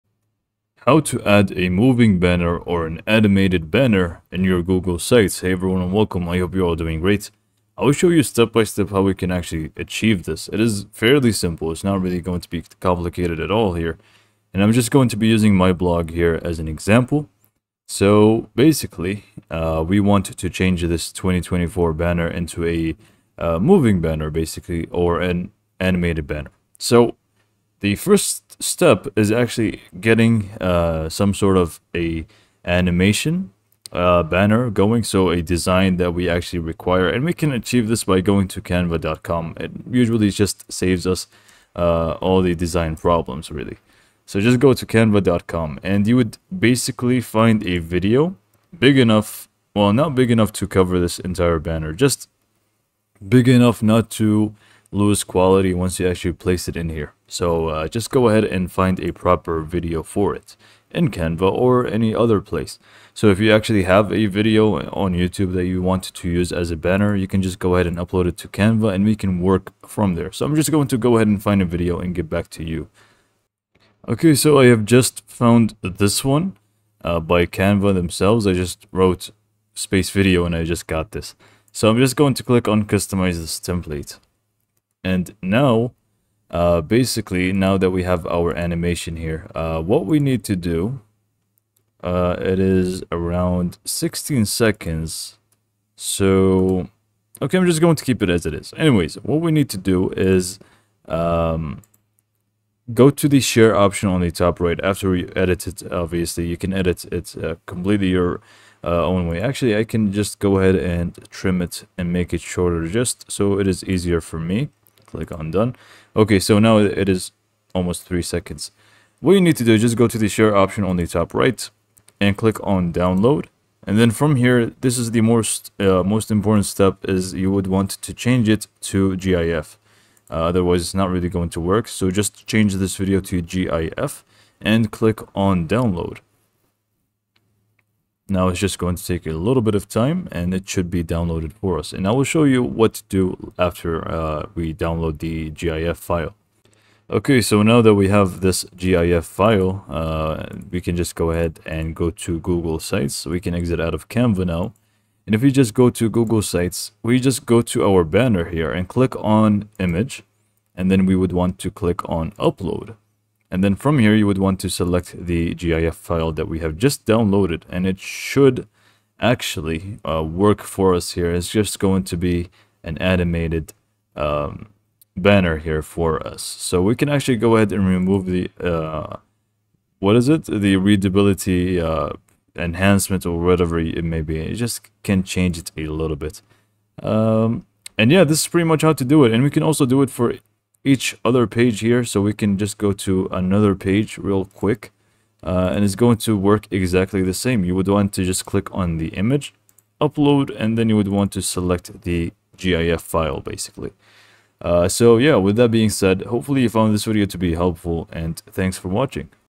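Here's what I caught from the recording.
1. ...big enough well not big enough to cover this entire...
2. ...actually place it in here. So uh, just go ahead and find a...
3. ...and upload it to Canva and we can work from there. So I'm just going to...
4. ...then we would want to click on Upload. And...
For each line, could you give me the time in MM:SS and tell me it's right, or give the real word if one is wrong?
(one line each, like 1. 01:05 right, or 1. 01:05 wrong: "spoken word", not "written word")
1. 00:48 right
2. 00:56 right
3. 01:07 right
4. 02:40 right.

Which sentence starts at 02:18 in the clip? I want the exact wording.
Now it's just going to take a little bit of time and it should be downloaded for us.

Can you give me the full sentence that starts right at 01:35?
So, okay, I'm just going to keep it as it is.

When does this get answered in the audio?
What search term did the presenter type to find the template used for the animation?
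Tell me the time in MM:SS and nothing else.
01:19.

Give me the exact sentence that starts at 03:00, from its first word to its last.
The readability uh, enhancement or whatever it may be.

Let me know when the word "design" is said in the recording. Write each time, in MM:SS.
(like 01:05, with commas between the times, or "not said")
00:35, 00:42.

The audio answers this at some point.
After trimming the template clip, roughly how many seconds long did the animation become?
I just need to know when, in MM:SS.
01:58.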